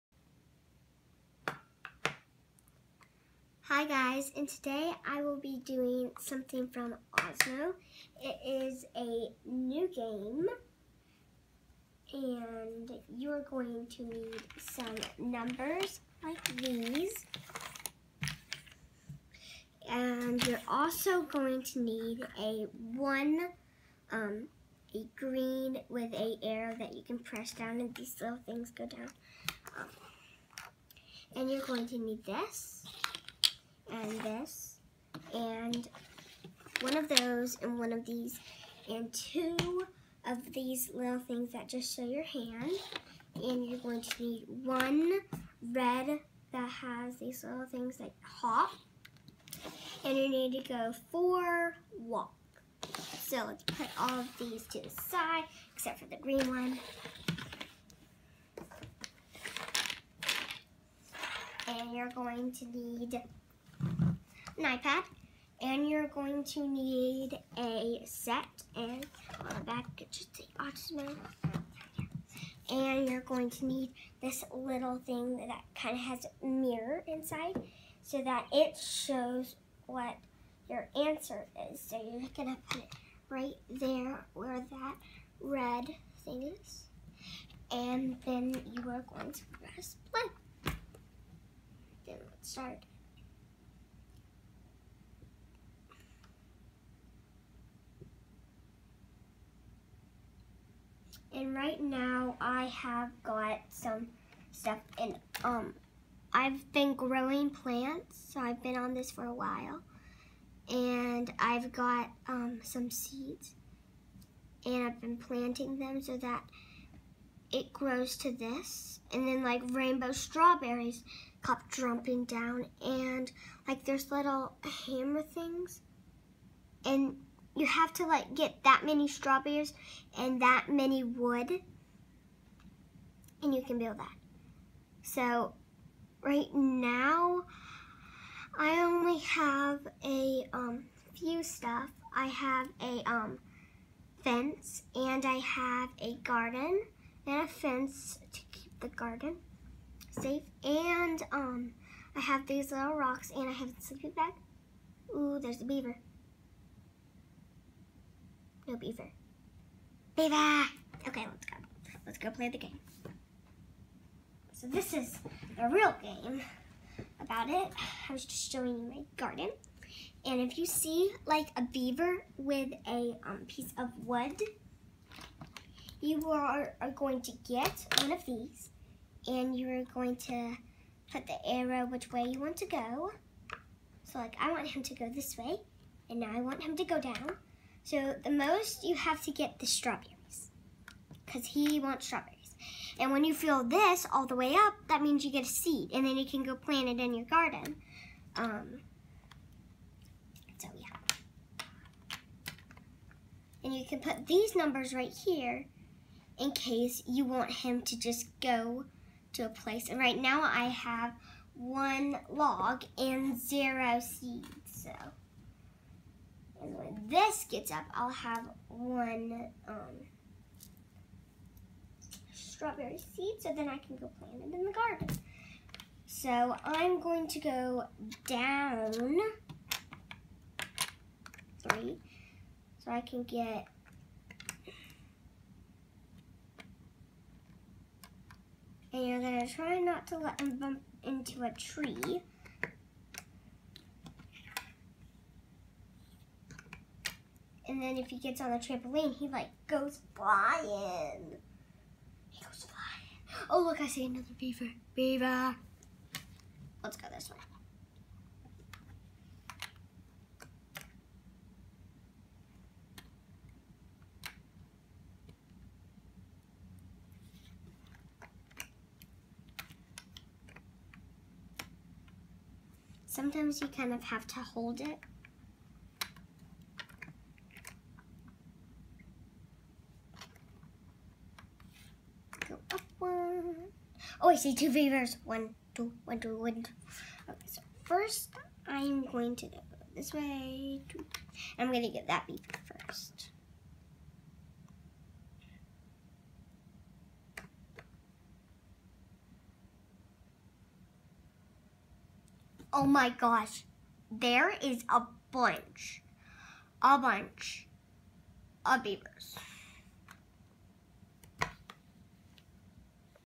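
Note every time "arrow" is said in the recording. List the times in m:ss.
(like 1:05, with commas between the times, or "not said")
0:26, 3:01.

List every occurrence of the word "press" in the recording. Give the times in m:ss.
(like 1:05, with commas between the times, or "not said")
0:27, 1:29.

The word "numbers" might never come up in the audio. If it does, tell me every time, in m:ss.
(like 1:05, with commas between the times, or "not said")
0:15, 3:24.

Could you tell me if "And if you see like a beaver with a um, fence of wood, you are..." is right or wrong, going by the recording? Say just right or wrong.
wrong.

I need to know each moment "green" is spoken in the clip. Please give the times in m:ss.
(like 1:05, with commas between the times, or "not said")
0:25, 0:56.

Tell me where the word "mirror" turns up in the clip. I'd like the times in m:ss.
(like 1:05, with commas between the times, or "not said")
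1:16.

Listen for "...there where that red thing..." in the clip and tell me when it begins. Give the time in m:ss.
1:23.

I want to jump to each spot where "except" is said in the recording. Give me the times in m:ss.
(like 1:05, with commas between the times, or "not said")
0:55.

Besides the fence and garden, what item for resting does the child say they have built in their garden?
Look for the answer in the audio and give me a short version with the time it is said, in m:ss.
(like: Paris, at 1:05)
A sleeping bag, at 2:33.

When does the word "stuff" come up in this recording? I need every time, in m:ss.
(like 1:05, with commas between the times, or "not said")
1:44, 2:21.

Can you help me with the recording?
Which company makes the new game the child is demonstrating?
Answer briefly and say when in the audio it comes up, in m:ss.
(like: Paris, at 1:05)
Osmo, at 0:07.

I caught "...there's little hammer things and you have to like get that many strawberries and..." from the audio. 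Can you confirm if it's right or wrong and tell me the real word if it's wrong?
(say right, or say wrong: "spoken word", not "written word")
right.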